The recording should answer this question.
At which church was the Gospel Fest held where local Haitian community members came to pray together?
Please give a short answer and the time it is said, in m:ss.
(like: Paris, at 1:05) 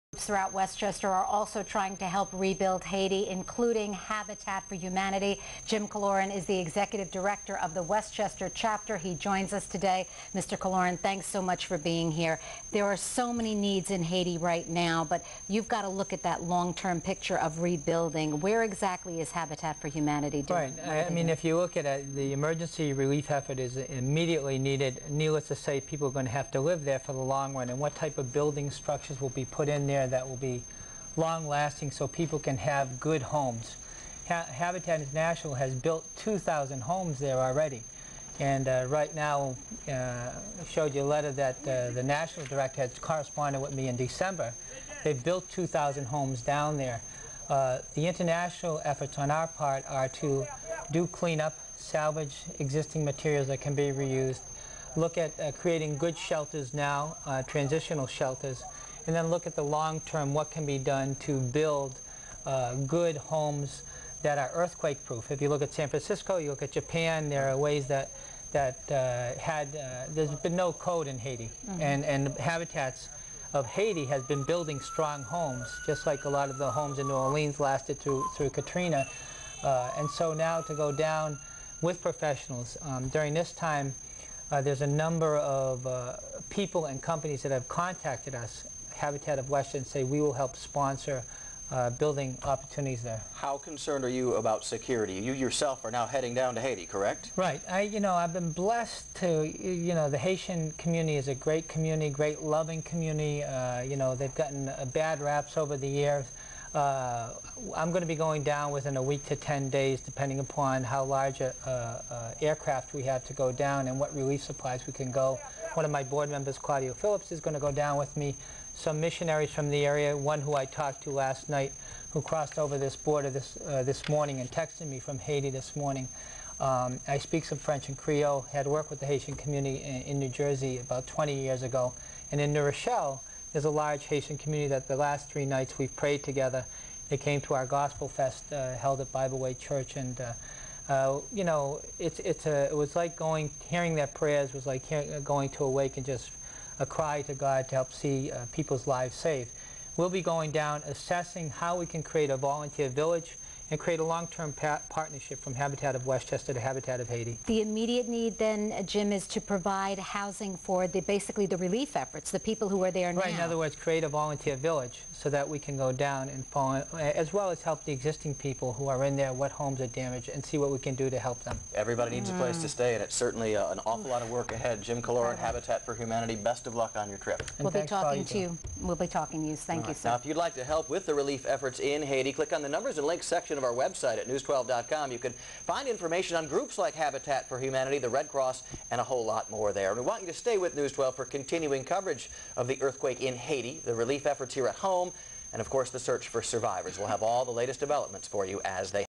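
Bible Way Church, at 2:19.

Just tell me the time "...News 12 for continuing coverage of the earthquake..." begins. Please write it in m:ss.
3:10.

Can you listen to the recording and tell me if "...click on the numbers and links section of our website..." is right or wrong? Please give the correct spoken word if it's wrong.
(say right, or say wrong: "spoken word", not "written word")
right.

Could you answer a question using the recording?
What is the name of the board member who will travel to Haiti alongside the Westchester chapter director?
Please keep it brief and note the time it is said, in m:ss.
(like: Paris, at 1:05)
Claudio Phillips, at 1:56.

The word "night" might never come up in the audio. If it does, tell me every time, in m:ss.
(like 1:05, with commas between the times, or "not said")
2:01, 2:15.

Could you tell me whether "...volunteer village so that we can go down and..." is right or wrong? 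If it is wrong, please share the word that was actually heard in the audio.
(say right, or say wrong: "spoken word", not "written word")
right.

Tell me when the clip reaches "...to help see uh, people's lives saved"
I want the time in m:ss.
2:27.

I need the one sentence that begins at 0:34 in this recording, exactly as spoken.
Ha Habitat International has built 2,000 homes there already.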